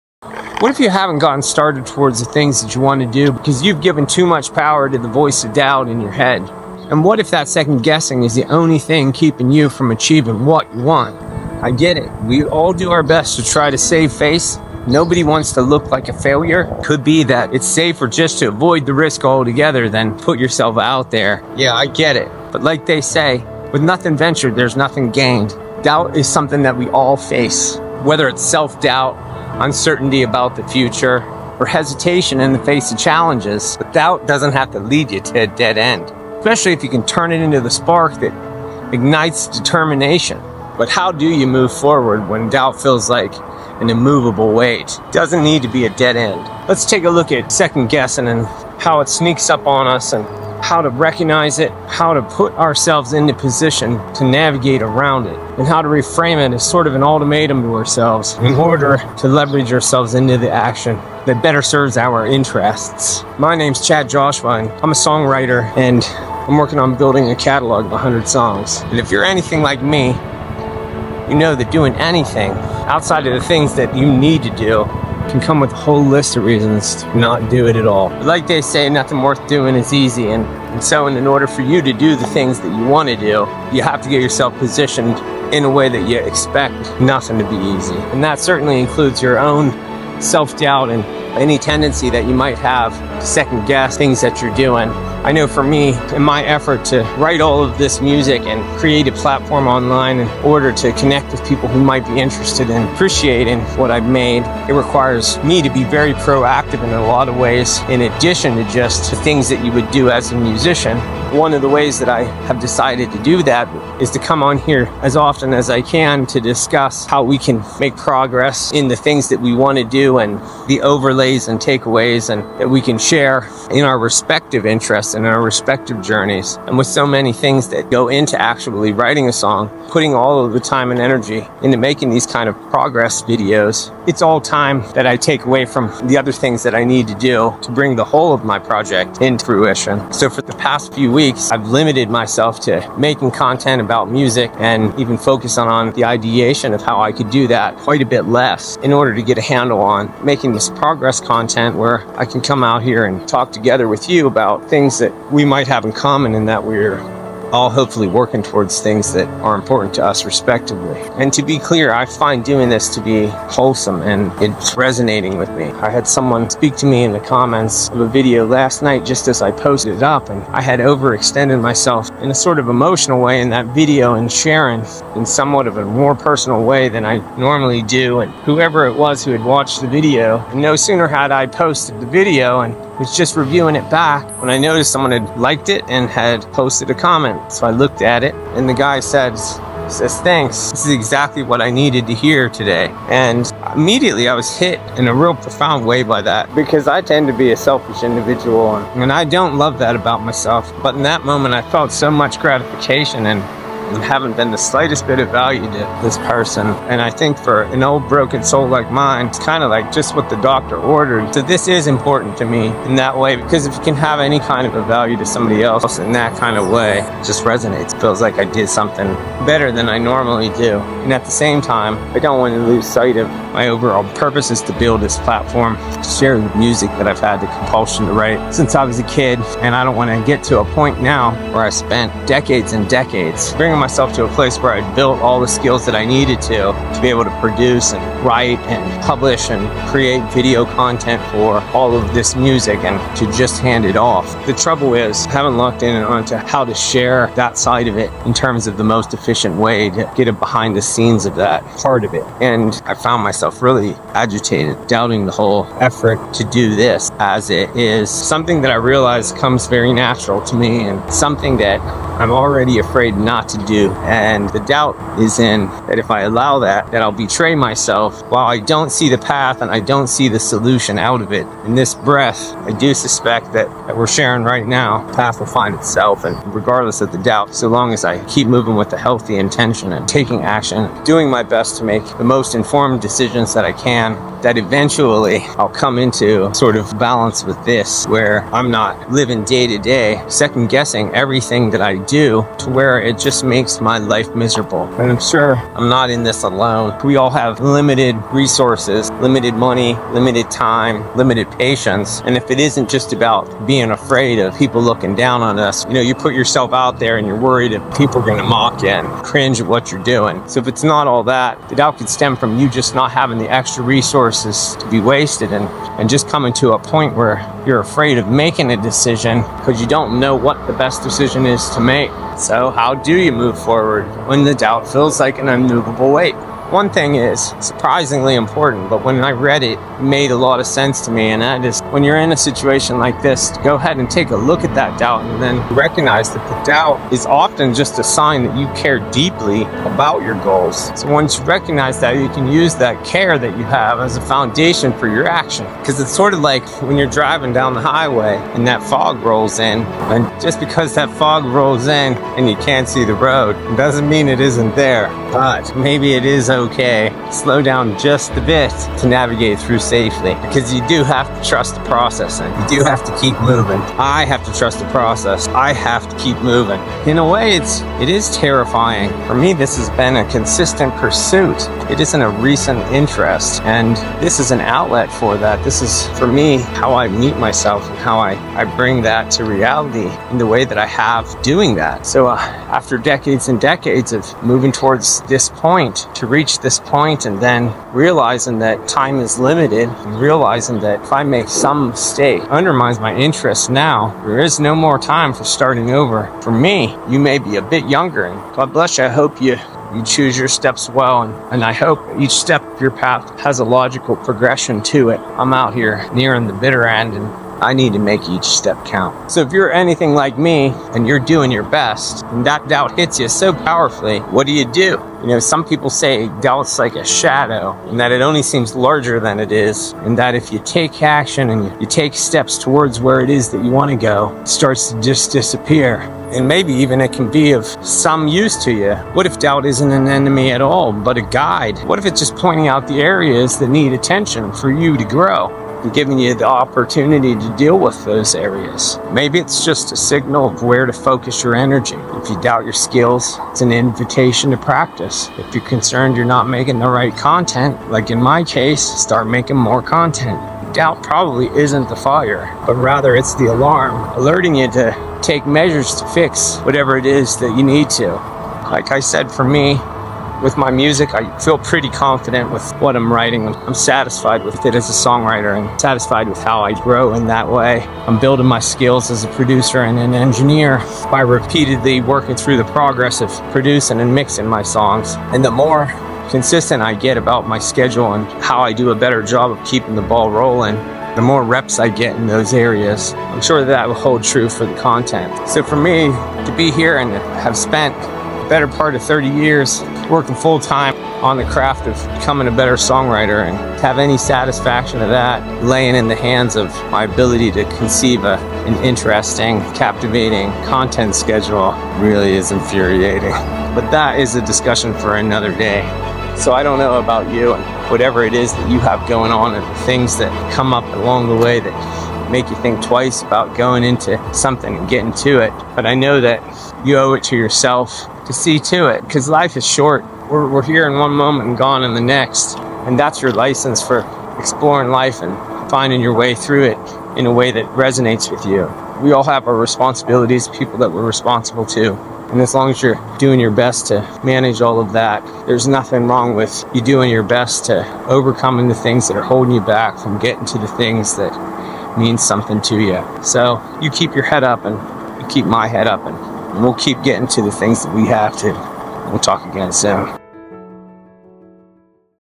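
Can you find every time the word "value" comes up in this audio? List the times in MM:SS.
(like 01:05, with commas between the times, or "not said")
03:25, 03:34.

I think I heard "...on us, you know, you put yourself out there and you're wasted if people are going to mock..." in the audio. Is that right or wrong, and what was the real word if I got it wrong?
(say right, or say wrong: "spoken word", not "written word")
wrong: "worried", not "wasted".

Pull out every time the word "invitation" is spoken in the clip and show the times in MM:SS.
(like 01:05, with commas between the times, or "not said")
07:23.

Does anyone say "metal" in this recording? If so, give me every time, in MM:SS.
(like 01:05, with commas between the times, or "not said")
not said.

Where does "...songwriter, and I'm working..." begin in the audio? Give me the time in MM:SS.
01:04.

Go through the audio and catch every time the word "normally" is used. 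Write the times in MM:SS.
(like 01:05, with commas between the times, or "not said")
02:57, 03:39.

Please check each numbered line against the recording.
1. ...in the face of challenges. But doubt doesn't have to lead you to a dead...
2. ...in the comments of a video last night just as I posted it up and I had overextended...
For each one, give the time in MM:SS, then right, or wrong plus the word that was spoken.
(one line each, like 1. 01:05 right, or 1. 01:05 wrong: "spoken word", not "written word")
1. 00:32 right
2. 02:47 right.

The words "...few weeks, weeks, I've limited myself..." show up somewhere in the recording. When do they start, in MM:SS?
02:20.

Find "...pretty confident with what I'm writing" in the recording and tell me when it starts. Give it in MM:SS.
07:41.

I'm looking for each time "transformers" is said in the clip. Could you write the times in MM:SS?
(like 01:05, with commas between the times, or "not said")
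not said.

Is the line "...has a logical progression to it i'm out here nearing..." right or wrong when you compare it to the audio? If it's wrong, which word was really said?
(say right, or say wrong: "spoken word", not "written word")
right.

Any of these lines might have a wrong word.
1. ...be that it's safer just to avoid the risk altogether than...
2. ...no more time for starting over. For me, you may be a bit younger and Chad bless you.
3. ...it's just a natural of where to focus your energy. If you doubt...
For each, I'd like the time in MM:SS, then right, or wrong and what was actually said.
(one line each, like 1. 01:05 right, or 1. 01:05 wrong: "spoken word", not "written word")
1. 00:17 right
2. 06:34 wrong: "God", not "Chad"
3. 07:19 wrong: "signal", not "natural".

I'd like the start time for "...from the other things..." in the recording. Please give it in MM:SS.
02:15.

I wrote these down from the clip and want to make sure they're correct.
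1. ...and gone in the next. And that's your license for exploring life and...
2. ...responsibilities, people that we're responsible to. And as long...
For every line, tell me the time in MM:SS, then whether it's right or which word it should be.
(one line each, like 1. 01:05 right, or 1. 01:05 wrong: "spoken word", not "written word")
1. 08:41 right
2. 08:49 right.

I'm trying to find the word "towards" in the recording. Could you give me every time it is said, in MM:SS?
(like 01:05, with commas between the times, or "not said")
00:01, 02:38, 06:24, 07:02.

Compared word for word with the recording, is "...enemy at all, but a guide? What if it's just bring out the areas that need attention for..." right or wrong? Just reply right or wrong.
wrong.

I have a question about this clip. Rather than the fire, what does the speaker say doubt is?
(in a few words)
the alarm.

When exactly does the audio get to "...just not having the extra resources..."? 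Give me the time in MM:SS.
05:12.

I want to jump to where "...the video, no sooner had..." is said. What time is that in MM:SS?
02:59.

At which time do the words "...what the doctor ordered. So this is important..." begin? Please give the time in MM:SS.
03:30.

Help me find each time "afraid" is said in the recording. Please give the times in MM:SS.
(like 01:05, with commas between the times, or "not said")
04:22, 05:03, 05:17.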